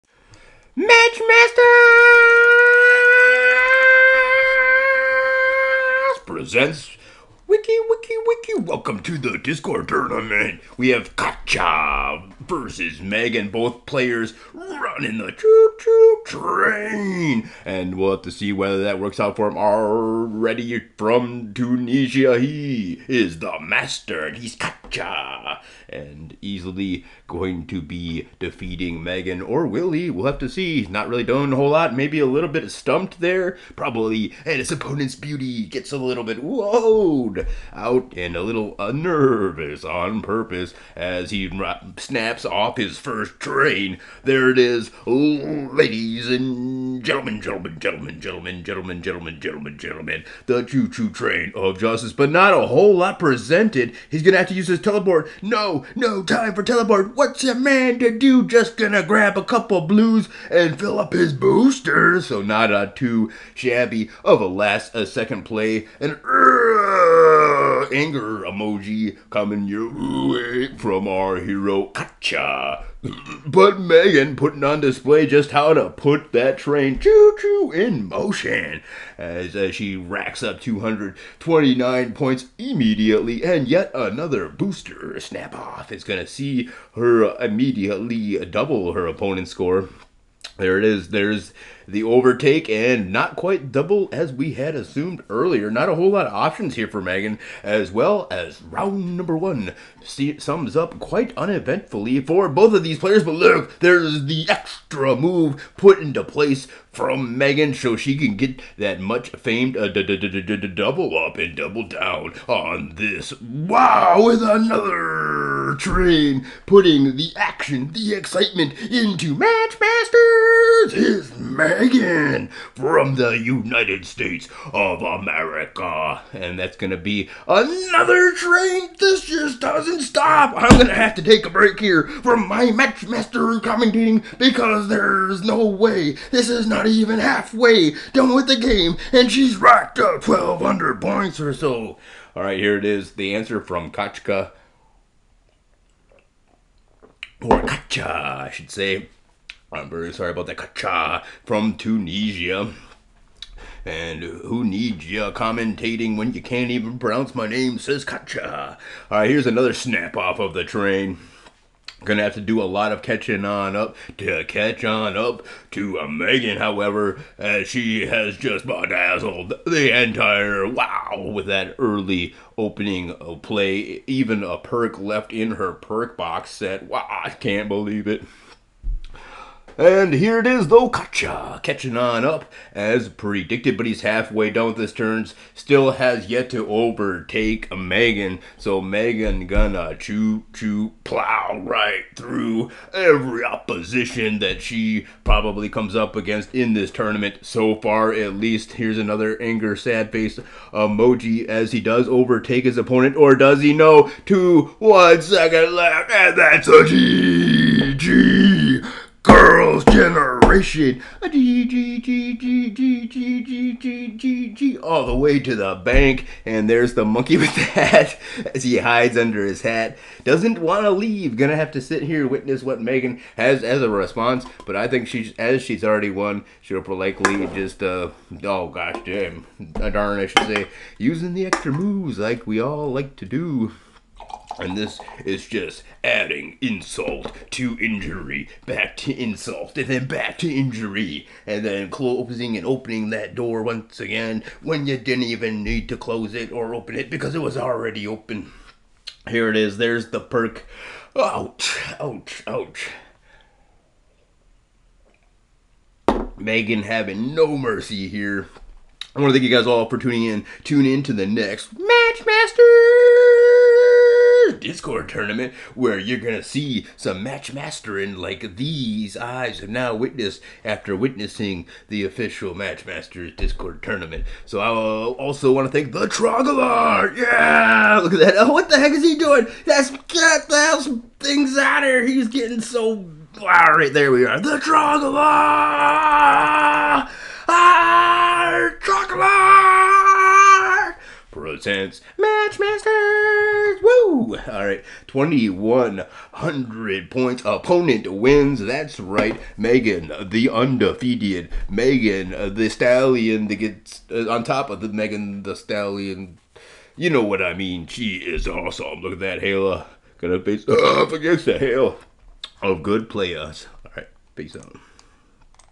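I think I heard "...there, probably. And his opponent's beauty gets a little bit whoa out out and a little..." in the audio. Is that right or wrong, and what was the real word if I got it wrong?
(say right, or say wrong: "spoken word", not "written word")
right.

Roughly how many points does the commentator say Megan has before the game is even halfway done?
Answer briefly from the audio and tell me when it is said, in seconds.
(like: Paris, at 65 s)
1,200, at 140 s.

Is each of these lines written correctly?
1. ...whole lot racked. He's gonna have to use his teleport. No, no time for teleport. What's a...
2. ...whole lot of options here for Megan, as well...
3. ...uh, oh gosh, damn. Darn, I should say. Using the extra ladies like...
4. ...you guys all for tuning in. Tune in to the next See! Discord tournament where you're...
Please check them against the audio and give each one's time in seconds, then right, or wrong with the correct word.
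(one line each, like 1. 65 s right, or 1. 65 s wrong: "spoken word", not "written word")
1. 52 s wrong: "presented", not "racked"
2. 95 s right
3. 227 s wrong: "moves", not "ladies"
4. 259 s wrong: "Matchmaster", not "See".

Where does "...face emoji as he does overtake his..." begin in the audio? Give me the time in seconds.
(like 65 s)
200 s.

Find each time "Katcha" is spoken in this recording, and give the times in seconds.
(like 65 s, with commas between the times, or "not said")
11 s, 24 s.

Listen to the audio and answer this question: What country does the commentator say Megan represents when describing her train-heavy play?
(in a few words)
United States of America.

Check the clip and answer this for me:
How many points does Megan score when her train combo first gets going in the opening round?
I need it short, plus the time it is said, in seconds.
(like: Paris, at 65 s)
229, at 80 s.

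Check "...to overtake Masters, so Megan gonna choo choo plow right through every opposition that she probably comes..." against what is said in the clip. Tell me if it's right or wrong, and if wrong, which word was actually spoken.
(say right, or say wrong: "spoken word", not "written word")
wrong: "Megan", not "Masters".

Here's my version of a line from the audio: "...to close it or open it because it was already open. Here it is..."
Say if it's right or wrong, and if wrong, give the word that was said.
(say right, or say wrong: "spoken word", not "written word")
right.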